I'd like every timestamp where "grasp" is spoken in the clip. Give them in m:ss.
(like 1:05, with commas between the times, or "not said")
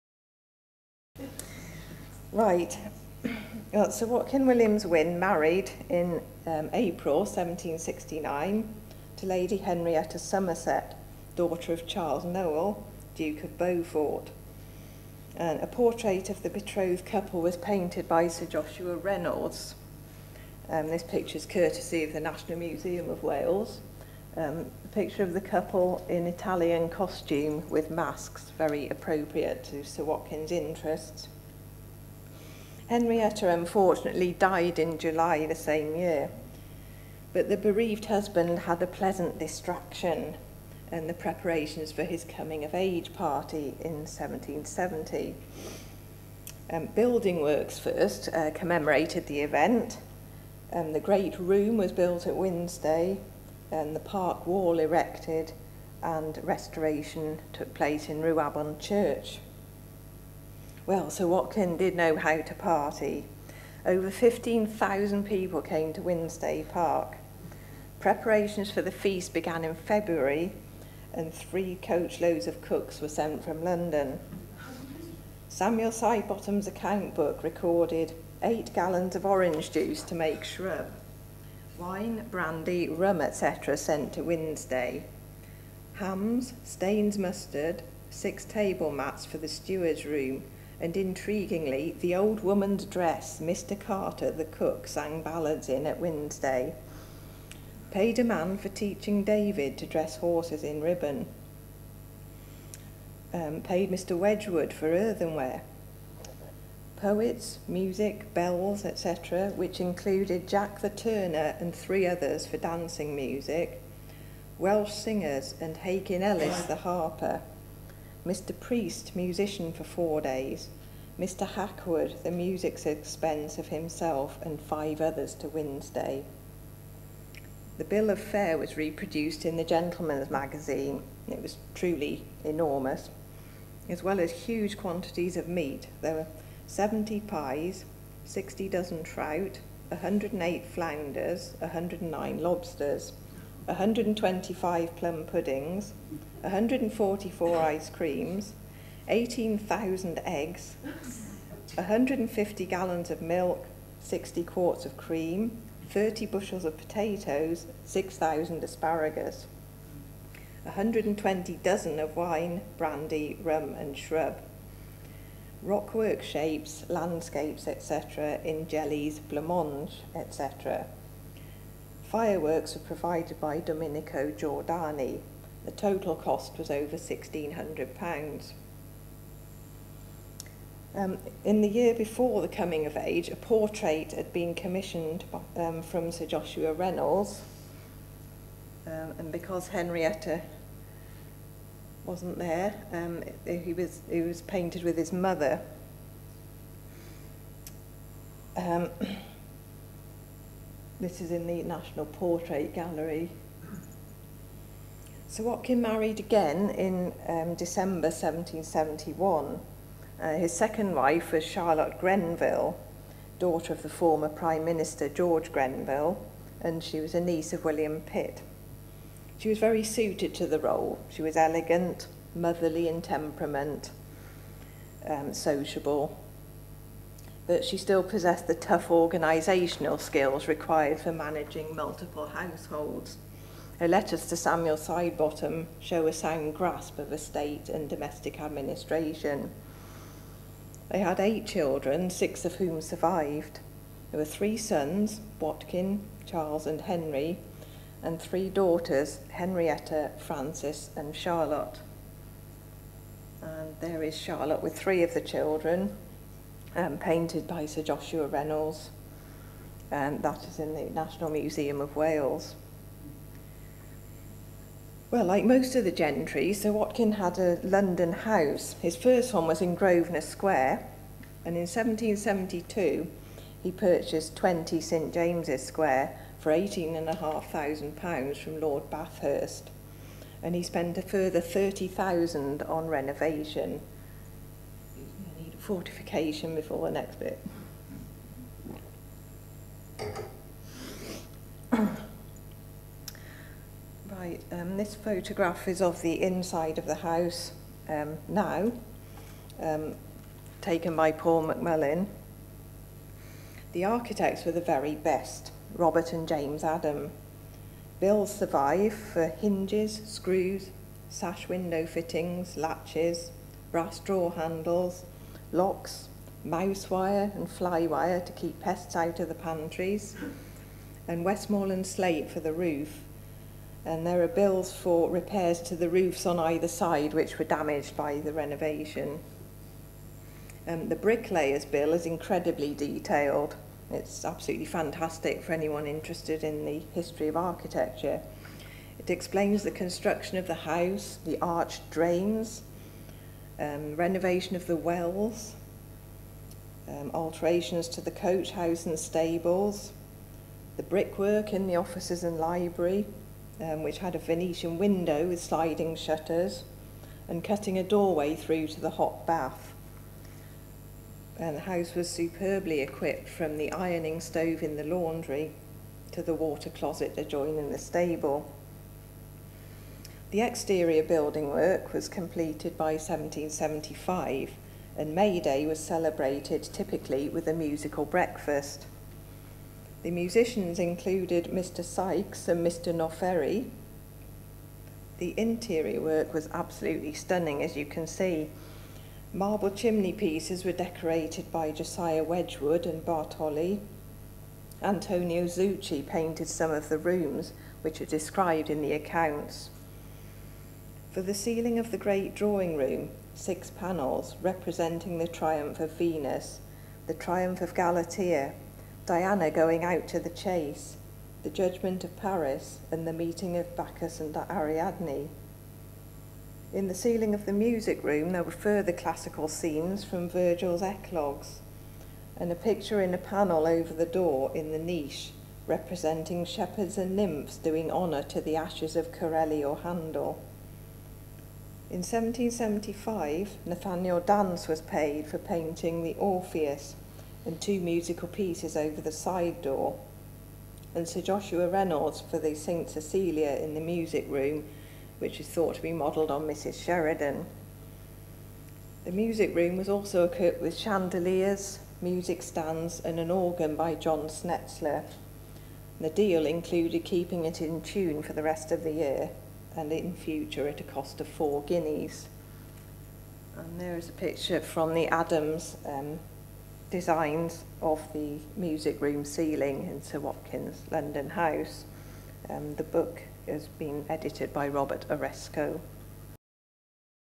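3:56.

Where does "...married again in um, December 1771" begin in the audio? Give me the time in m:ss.
3:25.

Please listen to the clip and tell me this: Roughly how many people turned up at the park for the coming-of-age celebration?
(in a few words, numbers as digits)
Over 15,000.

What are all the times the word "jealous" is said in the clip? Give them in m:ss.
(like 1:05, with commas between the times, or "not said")
not said.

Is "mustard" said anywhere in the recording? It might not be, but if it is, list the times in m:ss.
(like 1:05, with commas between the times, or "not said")
1:27.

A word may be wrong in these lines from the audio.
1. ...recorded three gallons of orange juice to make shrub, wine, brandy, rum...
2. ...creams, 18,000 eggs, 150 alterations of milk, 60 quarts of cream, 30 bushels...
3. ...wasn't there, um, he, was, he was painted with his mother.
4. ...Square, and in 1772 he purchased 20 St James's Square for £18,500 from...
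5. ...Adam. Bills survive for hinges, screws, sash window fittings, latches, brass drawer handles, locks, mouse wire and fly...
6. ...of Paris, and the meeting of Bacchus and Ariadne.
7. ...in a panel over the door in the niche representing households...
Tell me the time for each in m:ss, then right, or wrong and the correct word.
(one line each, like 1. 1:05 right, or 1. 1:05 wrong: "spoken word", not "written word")
1. 1:17 wrong: "eight", not "three"
2. 2:27 wrong: "gallons", not "alterations"
3. 3:12 right
4. 4:30 right
5. 5:06 right
6. 6:52 right
7. 7:03 wrong: "shepherds", not "households".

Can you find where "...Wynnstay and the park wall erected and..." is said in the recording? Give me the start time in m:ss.
0:52.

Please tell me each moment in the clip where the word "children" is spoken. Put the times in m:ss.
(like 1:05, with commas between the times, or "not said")
4:01, 4:15.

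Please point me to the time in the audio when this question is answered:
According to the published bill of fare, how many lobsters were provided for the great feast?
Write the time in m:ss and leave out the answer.
2:21.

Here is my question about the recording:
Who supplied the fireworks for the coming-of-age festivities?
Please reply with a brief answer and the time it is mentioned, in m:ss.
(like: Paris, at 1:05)
Domenico Giordani, at 2:53.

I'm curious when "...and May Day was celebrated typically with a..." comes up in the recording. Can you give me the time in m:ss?
6:14.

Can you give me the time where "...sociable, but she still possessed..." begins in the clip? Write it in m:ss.
3:45.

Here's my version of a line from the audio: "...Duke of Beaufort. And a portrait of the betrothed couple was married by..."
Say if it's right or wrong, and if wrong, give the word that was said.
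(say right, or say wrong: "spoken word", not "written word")
wrong: "painted", not "married".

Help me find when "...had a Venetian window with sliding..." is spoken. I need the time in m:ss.
5:53.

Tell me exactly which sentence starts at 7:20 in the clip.
And Sir Joshua Reynolds for the St Cecilia in the music room, which is thought to be modelled on Mrs Sheridan.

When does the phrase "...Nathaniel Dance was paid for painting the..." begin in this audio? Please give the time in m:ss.
7:13.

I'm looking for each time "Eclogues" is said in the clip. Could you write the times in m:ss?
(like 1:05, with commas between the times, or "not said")
7:00.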